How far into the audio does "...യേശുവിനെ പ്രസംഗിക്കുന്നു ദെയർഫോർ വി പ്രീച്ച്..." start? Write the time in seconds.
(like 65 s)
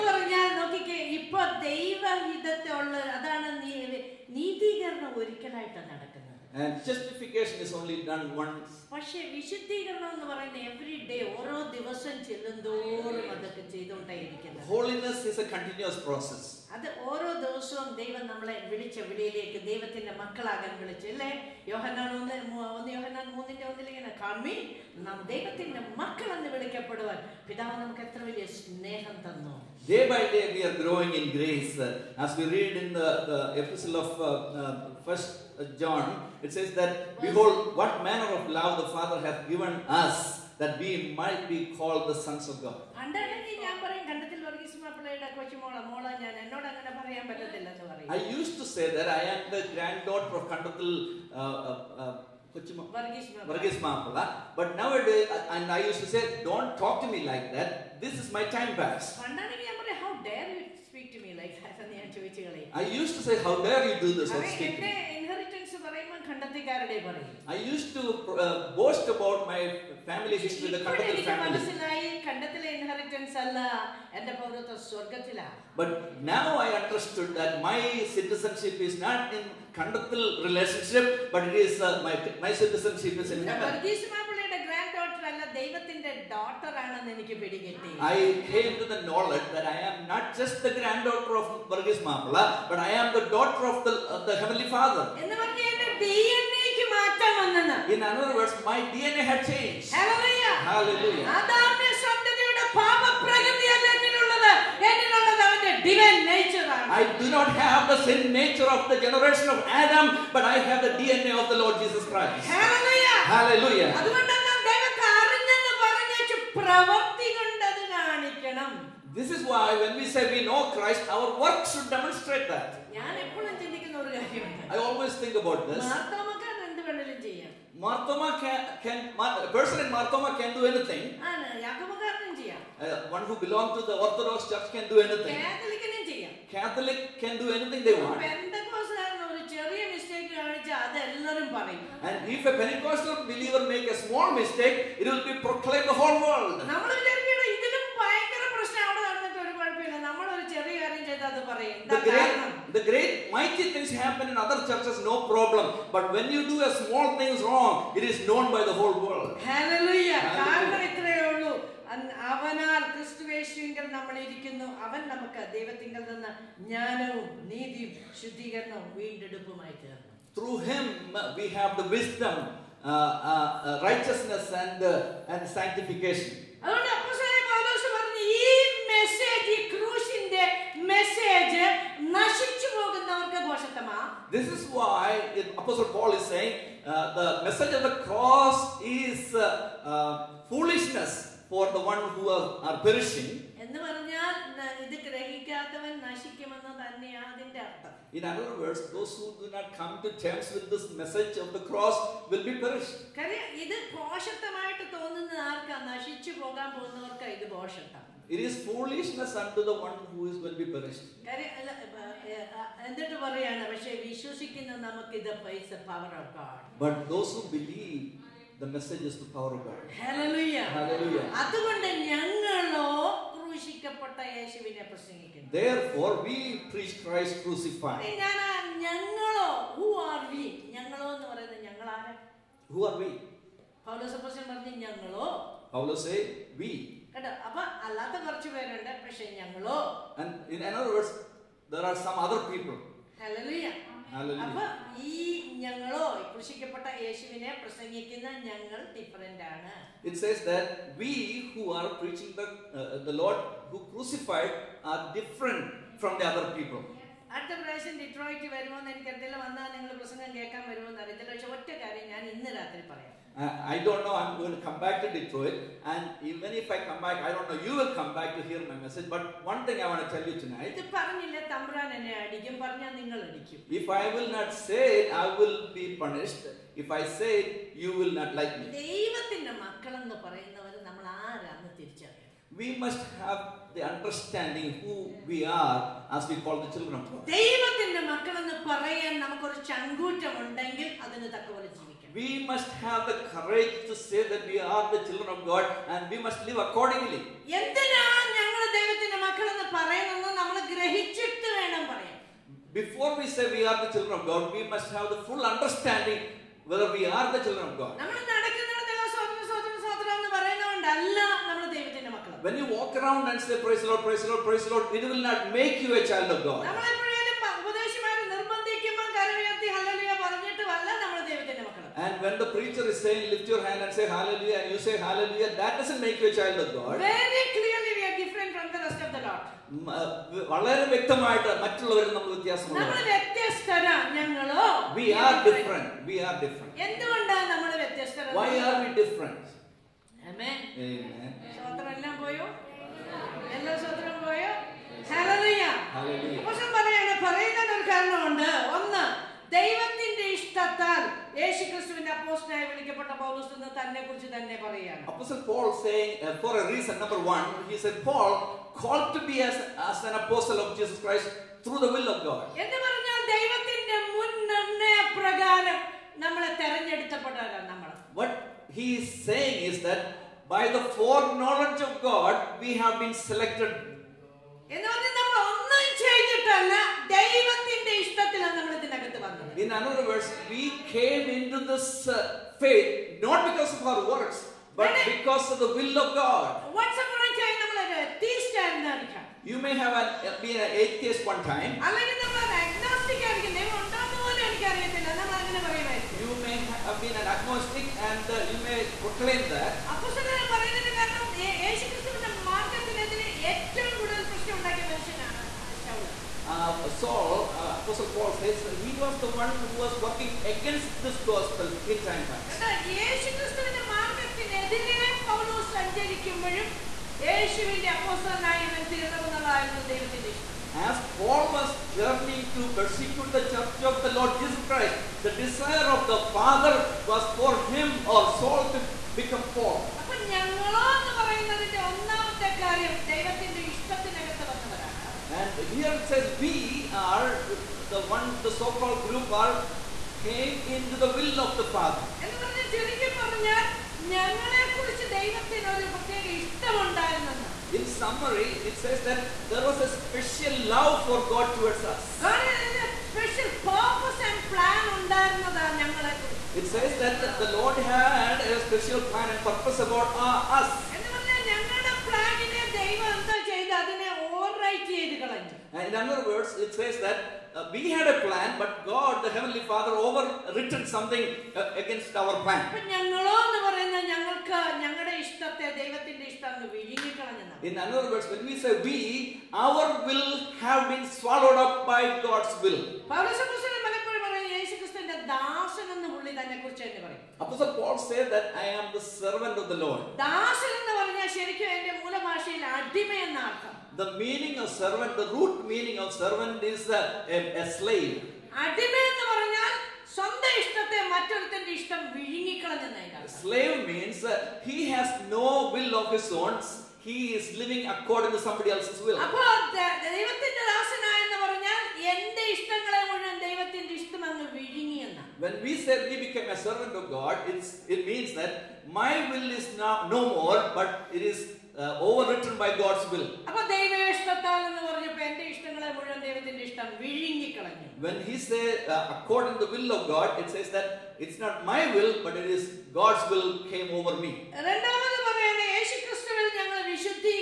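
224 s.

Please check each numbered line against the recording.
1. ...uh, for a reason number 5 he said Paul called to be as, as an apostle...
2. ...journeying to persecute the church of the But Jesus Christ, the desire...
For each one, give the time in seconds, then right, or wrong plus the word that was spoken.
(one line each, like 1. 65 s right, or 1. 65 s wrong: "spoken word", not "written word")
1. 356 s wrong: "1", not "5"
2. 421 s wrong: "Lord", not "But".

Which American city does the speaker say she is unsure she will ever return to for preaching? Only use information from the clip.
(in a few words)
Detroit.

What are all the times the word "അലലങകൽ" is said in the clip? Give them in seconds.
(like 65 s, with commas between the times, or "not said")
391 s.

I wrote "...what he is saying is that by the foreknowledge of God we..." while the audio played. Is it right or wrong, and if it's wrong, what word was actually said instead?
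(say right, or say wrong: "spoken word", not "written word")
right.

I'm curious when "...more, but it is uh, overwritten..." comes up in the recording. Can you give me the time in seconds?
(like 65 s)
520 s.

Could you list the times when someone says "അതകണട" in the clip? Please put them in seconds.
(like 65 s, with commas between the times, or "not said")
176 s, 221 s.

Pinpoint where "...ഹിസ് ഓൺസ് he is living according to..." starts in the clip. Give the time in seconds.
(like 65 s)
506 s.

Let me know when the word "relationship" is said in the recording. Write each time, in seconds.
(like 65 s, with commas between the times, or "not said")
80 s.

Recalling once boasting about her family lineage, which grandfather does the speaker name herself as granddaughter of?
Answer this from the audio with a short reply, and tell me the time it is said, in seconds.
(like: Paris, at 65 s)
Varghese Mamala, at 91 s.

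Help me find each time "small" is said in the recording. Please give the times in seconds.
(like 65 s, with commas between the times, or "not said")
143 s, 156 s.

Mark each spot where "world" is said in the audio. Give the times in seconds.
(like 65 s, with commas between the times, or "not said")
146 s, 159 s.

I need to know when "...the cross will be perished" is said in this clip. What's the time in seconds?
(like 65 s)
201 s.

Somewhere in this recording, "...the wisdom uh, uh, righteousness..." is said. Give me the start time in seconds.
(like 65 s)
171 s.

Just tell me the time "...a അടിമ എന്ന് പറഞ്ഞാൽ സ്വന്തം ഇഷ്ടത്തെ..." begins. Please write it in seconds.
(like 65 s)
497 s.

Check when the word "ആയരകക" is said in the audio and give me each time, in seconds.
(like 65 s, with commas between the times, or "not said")
393 s.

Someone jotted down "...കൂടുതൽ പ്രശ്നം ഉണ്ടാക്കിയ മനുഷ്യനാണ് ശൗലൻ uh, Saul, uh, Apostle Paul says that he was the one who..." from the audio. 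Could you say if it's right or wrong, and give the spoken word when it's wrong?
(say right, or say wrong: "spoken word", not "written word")
right.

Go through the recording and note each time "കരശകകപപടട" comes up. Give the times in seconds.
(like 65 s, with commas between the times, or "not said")
223 s, 246 s.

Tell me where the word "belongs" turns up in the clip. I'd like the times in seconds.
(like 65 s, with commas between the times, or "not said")
133 s.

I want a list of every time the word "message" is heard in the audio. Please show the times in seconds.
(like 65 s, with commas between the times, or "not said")
187 s, 201 s, 268 s.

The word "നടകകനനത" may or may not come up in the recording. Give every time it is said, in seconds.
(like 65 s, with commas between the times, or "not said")
5 s.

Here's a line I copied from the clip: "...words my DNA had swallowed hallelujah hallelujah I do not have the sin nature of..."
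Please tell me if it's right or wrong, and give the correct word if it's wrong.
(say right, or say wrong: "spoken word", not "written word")
wrong: "changed", not "swallowed".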